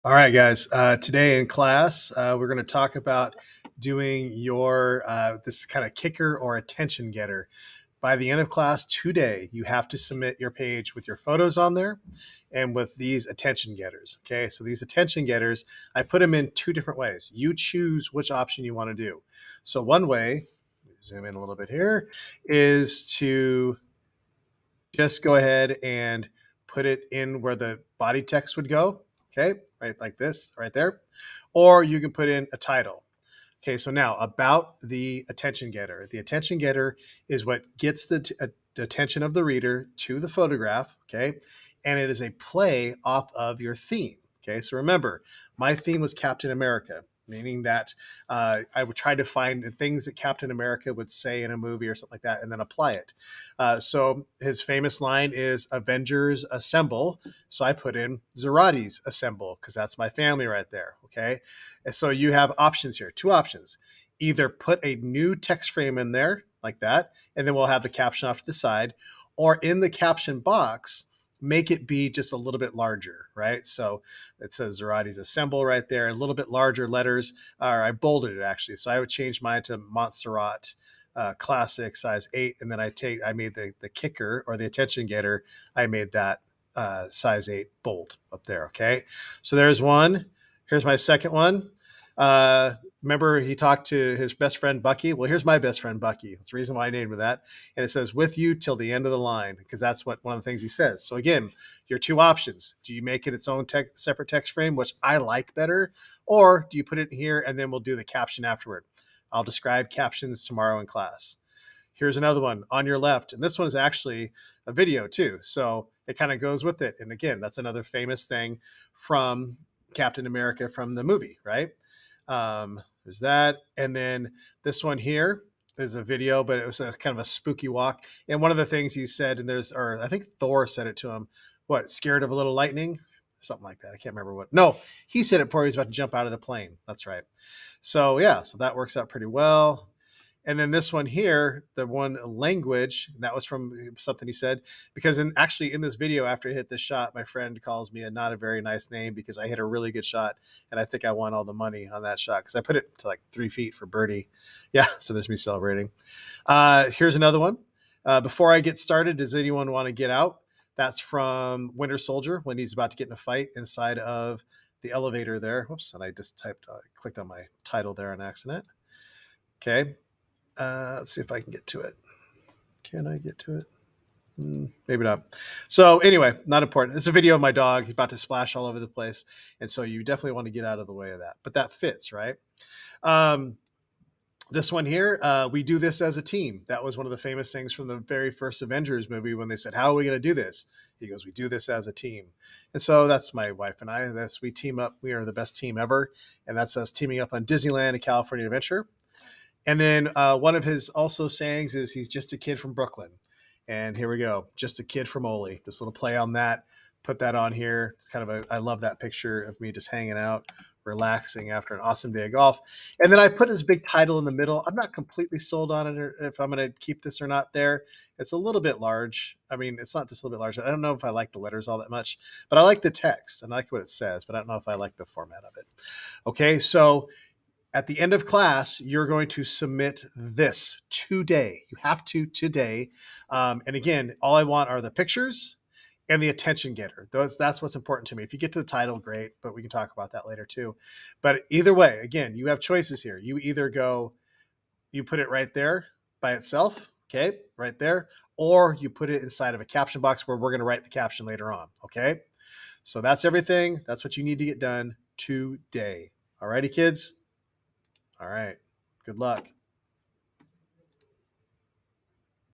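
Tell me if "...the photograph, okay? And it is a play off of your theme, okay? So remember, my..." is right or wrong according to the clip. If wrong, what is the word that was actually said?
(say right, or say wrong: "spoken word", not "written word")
right.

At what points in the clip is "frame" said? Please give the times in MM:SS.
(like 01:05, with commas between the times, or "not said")
01:05, 01:44.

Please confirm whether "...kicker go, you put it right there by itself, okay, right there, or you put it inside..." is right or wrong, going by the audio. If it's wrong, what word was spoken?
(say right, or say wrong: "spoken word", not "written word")
wrong: "either", not "kicker".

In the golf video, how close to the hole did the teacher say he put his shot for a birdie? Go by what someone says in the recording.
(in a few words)
3 feet.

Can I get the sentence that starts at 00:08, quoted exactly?
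By the end of class today, you have to submit your page with your photos on there and with these attention getters.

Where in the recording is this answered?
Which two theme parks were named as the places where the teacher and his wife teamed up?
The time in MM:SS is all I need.
03:17.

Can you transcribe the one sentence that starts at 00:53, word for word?
Uh, so his famous line is "Avengers Assemble." So I put in Zarate's Assemble because that's my family right there.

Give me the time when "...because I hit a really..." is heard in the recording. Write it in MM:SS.
02:29.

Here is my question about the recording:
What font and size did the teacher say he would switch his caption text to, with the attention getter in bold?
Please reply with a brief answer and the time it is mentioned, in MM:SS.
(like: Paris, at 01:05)
Montserrat size 8, at 01:19.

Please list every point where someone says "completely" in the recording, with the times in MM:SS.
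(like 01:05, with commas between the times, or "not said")
03:34.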